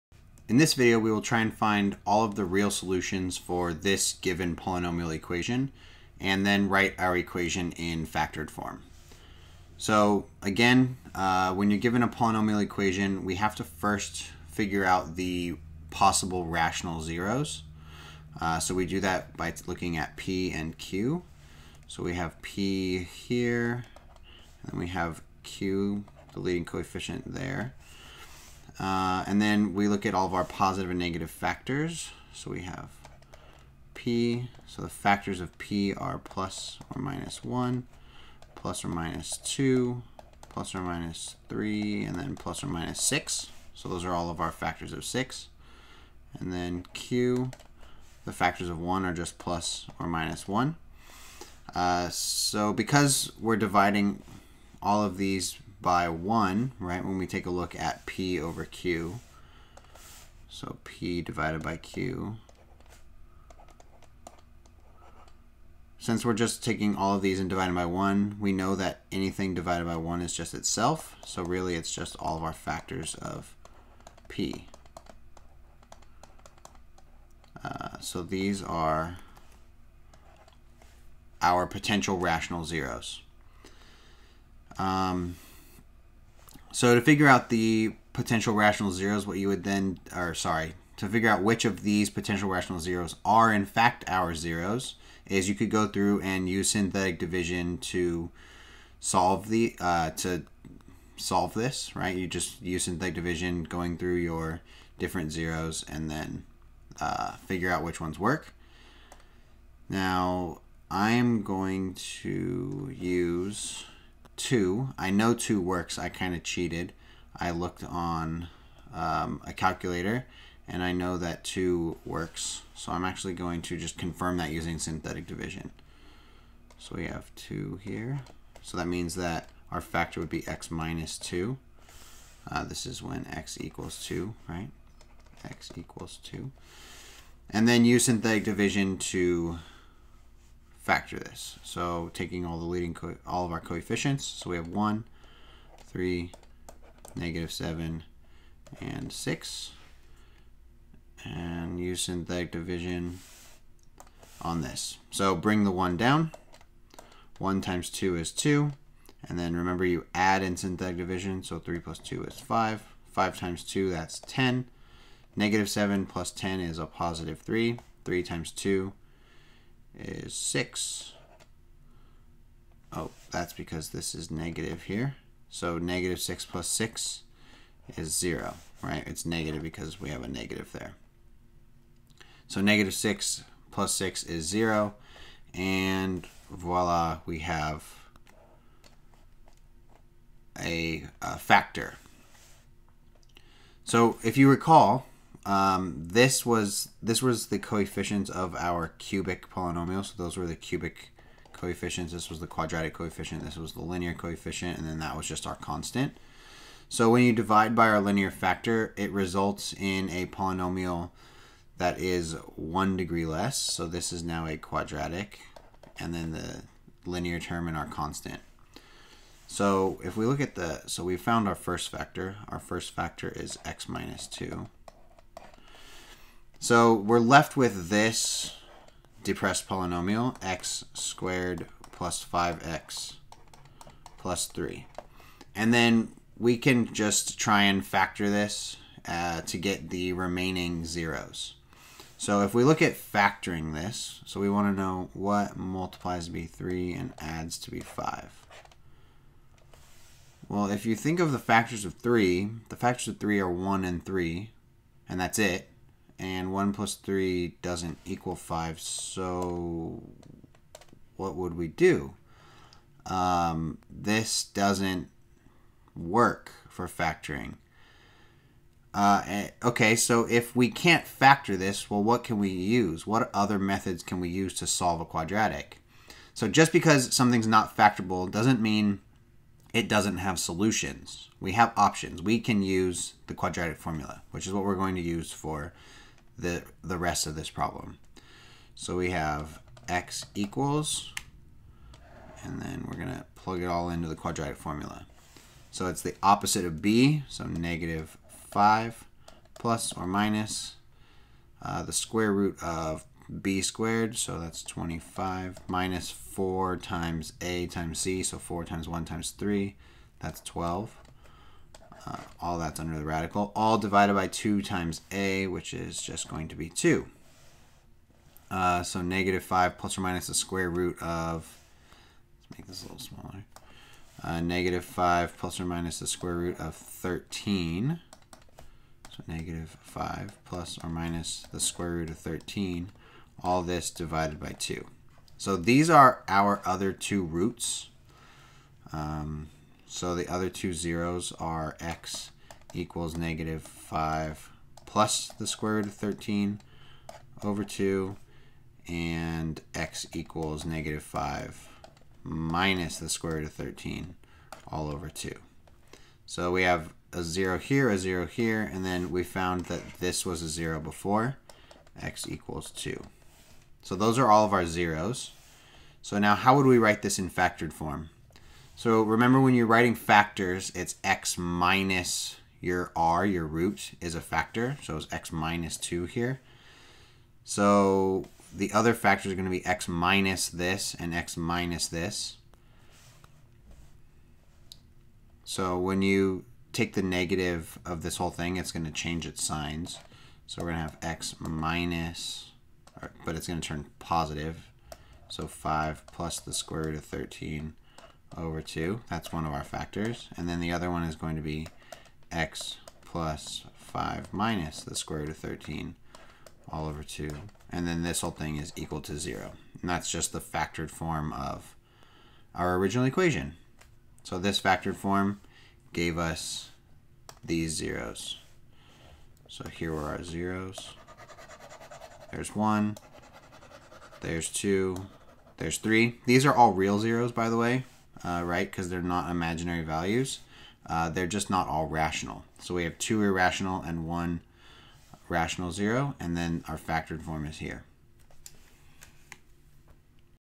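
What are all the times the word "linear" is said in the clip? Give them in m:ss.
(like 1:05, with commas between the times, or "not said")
3:23, 3:28, 3:37.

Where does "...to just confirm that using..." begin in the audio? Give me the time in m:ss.
2:03.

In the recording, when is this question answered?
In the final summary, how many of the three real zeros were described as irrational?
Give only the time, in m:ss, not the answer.
7:12.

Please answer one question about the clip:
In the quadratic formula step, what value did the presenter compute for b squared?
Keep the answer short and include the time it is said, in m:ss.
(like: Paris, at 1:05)
25, at 5:04.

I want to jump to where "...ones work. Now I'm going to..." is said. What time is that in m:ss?
1:47.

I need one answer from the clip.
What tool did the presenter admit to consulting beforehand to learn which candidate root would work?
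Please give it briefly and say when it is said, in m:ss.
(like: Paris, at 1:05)
A calculator, at 1:59.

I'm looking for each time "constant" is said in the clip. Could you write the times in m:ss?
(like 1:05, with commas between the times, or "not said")
3:25, 3:37.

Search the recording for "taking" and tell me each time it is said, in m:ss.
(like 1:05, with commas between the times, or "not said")
1:06, 2:22.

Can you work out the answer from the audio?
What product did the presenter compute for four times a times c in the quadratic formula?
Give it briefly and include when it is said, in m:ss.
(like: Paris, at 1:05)
12, at 5:10.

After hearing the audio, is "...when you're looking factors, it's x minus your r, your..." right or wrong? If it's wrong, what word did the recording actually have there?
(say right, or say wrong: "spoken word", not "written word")
wrong: "writing", not "looking".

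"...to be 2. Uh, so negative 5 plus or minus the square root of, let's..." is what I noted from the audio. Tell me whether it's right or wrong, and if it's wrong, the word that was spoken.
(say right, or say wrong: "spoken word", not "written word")
right.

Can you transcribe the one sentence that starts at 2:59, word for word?
It's negative because we have a negative there.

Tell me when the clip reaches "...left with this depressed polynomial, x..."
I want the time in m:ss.
3:47.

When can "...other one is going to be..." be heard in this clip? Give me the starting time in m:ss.
6:40.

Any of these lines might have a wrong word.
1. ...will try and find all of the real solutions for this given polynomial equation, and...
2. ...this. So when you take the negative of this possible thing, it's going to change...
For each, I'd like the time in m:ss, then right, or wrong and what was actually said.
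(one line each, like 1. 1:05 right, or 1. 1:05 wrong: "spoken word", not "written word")
1. 0:01 right
2. 6:21 wrong: "whole", not "possible".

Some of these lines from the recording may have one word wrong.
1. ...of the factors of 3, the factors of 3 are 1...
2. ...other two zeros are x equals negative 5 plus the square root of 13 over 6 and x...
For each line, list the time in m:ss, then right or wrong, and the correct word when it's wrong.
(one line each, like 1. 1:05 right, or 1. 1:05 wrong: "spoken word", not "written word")
1. 4:11 right
2. 5:40 wrong: "2", not "6".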